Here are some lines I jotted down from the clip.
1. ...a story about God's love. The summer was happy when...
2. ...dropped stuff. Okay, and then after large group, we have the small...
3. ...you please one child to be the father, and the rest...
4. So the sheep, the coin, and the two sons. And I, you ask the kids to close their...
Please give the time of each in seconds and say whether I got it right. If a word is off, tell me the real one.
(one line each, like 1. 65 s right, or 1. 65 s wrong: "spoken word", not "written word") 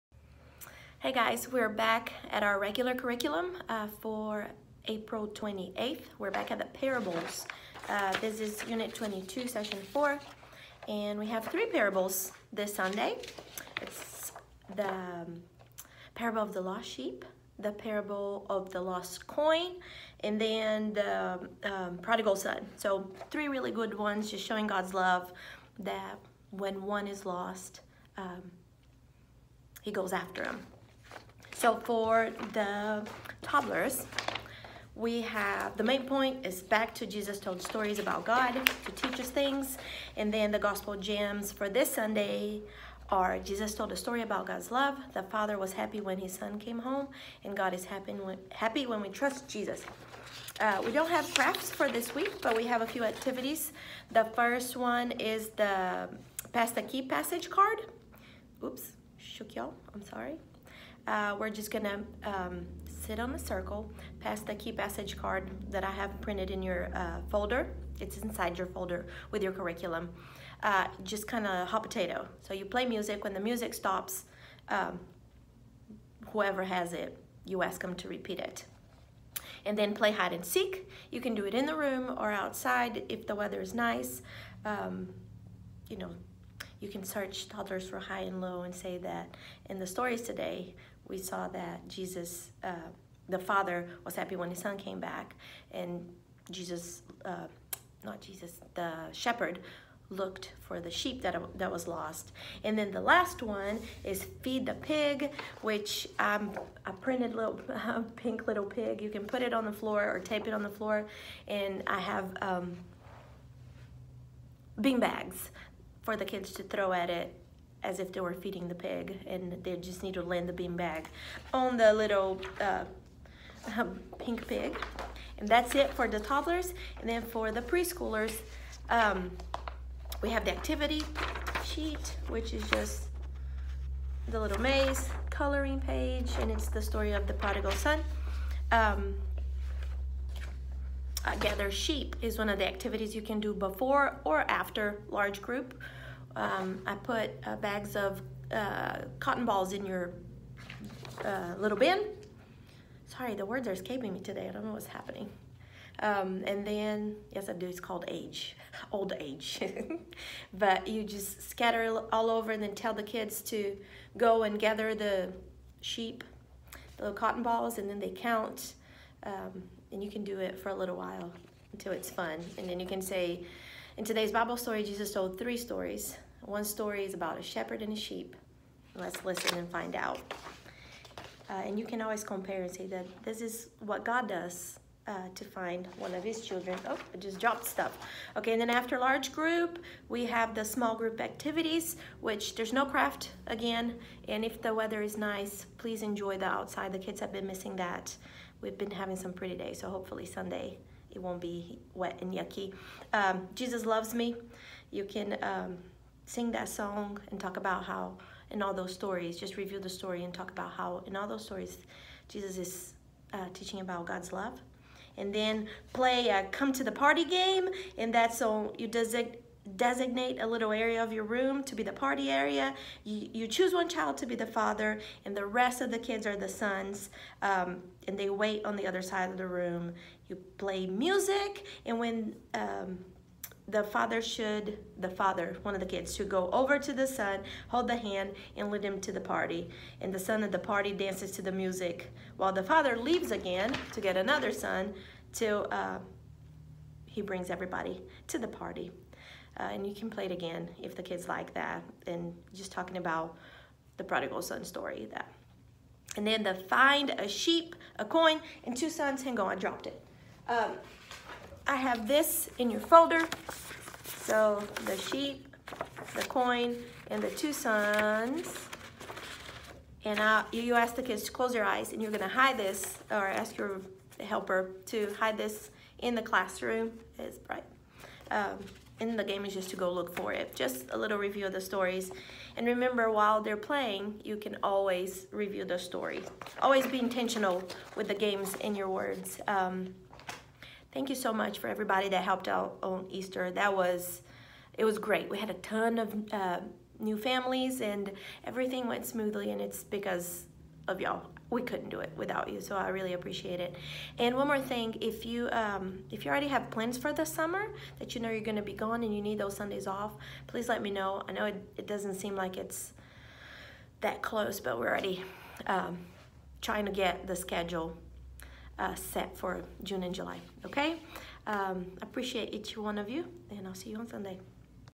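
1. 43 s wrong: "father", not "summer"
2. 187 s right
3. 223 s wrong: "choose", not "please"
4. 264 s right.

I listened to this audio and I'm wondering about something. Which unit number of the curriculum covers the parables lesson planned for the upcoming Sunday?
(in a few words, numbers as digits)
22.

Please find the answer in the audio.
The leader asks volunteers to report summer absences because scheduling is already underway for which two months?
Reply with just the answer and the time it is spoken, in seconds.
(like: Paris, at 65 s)
June and July, at 319 s.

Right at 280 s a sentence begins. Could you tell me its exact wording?
Just a little review of the stories.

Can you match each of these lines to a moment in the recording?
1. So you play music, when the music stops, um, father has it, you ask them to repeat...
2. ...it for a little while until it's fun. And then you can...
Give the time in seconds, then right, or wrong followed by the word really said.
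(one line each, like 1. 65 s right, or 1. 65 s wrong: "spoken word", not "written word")
1. 72 s wrong: "whoever", not "father"
2. 170 s right.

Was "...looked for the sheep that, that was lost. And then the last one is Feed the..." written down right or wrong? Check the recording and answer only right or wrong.
right.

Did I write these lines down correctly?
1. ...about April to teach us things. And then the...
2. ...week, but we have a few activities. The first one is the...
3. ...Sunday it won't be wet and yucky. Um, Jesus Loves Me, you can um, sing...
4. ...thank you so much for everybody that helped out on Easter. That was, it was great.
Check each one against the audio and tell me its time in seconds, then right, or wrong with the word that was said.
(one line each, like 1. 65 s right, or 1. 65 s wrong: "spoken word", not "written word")
1. 37 s wrong: "God", not "April"
2. 52 s right
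3. 200 s right
4. 290 s right.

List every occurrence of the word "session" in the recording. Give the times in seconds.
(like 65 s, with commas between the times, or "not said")
9 s.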